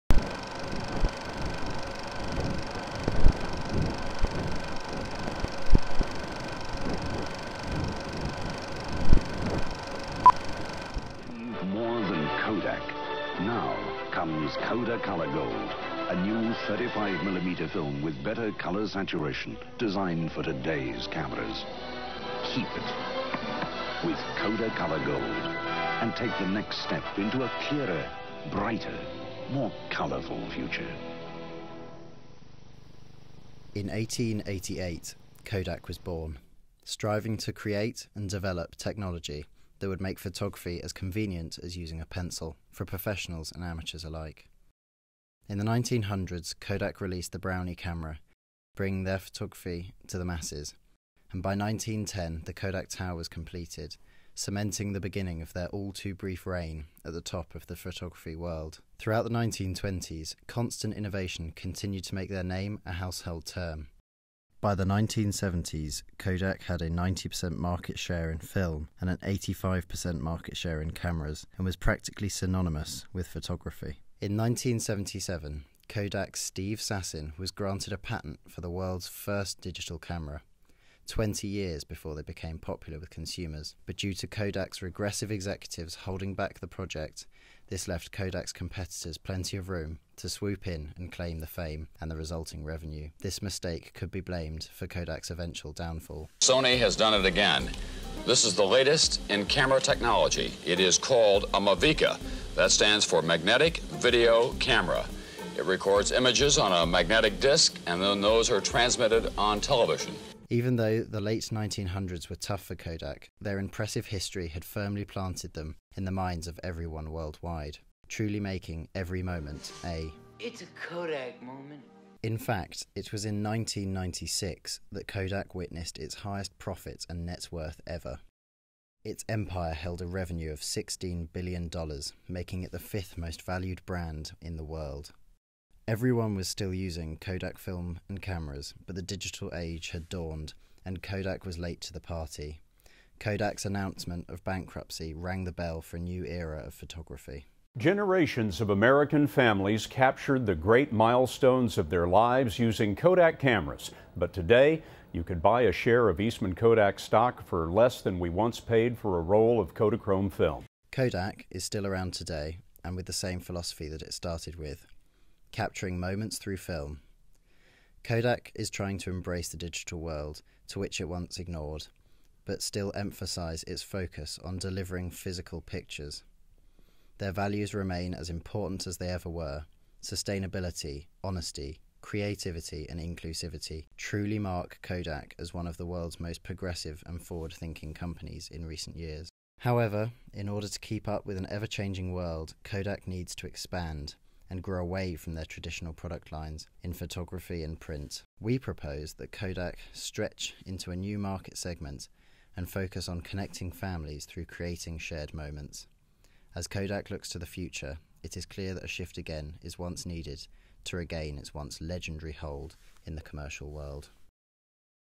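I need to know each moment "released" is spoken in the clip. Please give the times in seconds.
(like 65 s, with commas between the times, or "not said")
47 s.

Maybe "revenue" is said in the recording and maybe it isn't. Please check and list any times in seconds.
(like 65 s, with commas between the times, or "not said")
92 s, 130 s.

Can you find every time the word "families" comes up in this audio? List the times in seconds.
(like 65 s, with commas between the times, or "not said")
149 s, 203 s.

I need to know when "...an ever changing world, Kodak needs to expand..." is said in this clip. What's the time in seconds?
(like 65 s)
191 s.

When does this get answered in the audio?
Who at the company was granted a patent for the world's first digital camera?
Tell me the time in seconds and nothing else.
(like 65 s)
76 s.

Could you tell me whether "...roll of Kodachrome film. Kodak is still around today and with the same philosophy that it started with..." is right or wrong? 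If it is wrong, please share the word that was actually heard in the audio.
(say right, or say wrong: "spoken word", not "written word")
right.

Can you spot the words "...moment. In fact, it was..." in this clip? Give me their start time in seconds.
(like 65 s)
121 s.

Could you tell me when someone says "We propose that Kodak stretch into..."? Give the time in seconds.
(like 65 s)
198 s.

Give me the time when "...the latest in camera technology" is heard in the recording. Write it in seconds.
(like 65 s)
98 s.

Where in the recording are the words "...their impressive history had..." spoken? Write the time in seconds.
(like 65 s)
113 s.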